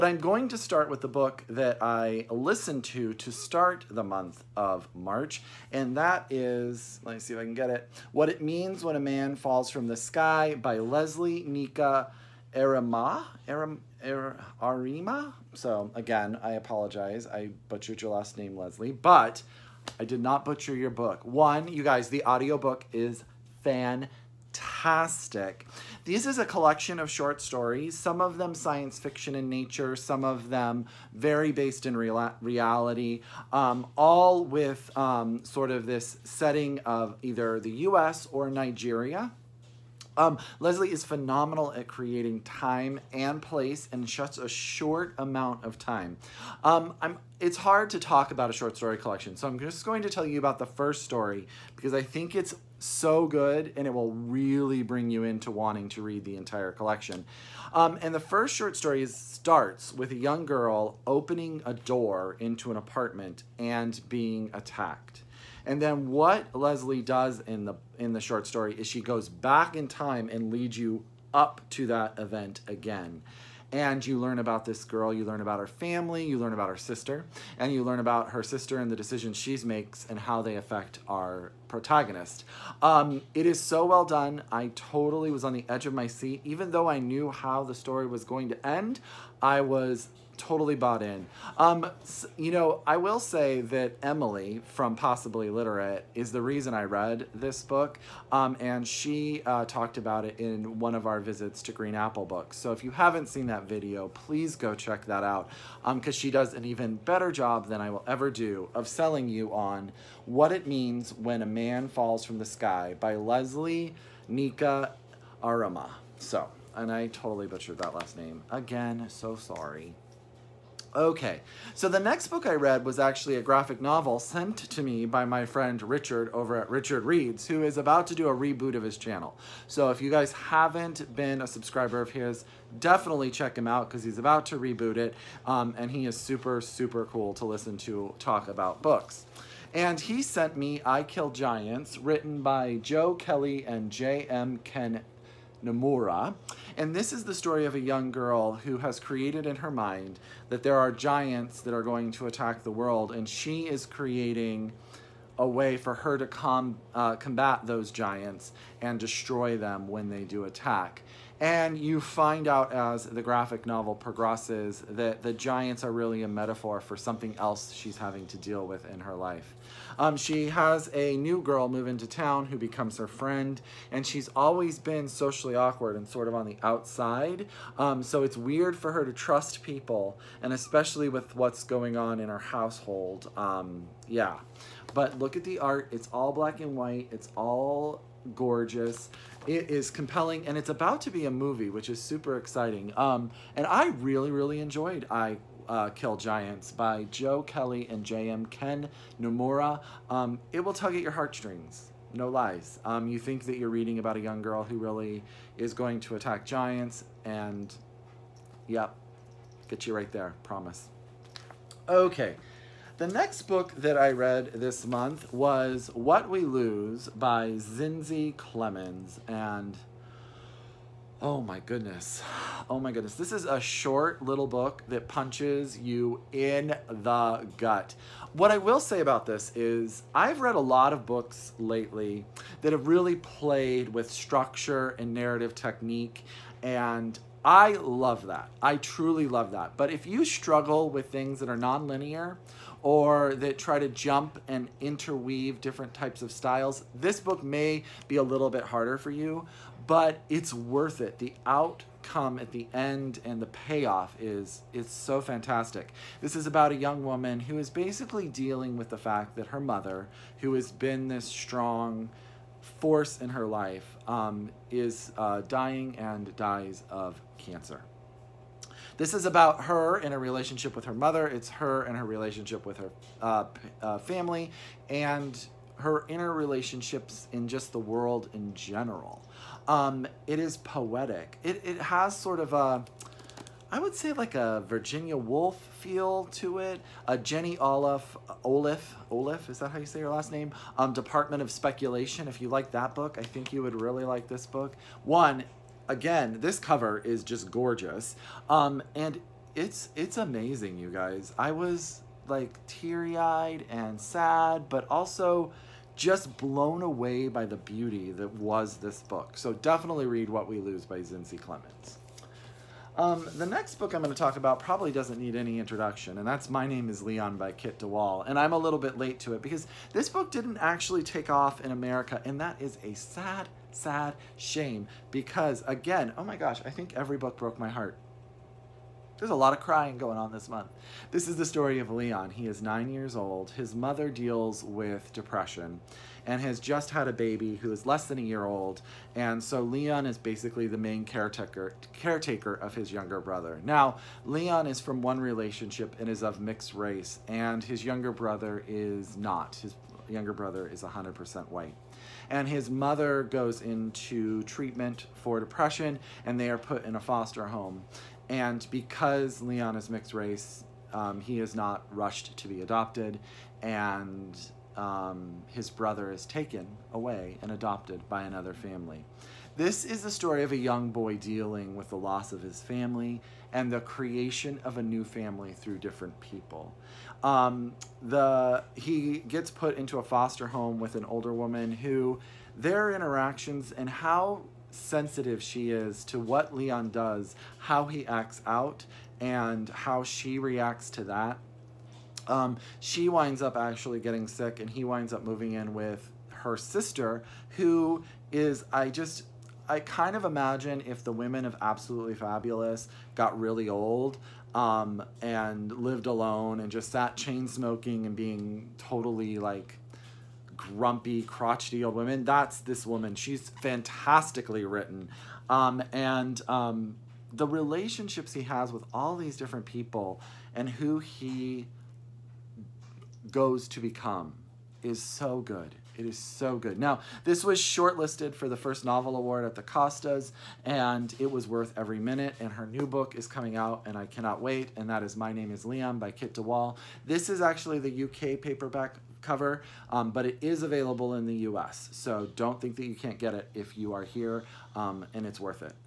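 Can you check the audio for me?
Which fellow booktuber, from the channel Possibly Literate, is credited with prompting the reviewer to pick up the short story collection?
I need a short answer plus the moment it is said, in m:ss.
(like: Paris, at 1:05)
Emily, at 1:34.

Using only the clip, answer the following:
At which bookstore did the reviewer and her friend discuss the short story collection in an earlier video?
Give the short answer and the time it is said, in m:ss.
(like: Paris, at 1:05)
Green Apple Books, at 1:41.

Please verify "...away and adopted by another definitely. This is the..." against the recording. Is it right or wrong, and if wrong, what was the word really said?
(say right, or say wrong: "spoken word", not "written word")
wrong: "family", not "definitely".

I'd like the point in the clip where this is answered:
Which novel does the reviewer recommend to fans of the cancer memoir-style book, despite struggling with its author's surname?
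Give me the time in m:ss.
4:50.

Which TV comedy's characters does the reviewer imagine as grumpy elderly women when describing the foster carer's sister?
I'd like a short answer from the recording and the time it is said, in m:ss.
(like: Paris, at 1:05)
Absolutely Fabulous, at 6:41.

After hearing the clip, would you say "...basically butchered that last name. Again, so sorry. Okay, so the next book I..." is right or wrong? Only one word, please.
wrong.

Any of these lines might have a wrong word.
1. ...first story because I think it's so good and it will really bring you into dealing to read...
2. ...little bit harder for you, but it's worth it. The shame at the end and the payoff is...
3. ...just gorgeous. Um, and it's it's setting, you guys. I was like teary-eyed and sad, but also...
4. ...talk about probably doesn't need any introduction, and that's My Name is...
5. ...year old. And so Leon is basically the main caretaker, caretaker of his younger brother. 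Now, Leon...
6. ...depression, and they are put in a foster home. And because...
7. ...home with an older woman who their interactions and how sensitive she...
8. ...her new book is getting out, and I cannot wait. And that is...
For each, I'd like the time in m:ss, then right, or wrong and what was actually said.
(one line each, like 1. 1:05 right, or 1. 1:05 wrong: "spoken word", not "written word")
1. 0:50 wrong: "wanting", not "dealing"
2. 4:08 wrong: "outcome", not "shame"
3. 4:57 wrong: "amazing", not "setting"
4. 5:14 right
5. 5:38 right
6. 5:55 right
7. 6:20 right
8. 7:12 wrong: "coming", not "getting".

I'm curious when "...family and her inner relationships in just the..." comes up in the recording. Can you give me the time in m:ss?
4:33.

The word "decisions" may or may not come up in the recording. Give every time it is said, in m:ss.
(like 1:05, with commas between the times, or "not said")
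1:18.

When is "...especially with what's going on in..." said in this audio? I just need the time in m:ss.
3:00.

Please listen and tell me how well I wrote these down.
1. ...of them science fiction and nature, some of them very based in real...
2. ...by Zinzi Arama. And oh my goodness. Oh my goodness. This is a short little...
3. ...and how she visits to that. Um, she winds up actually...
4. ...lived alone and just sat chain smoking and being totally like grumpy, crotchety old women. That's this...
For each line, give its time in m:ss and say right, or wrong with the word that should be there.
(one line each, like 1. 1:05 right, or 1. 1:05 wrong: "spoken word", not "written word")
1. 0:28 right
2. 3:37 wrong: "Clemmons", not "Arama"
3. 6:29 wrong: "reacts", not "visits"
4. 6:45 right.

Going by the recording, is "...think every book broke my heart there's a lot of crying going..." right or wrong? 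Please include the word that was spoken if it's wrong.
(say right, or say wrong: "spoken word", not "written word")
right.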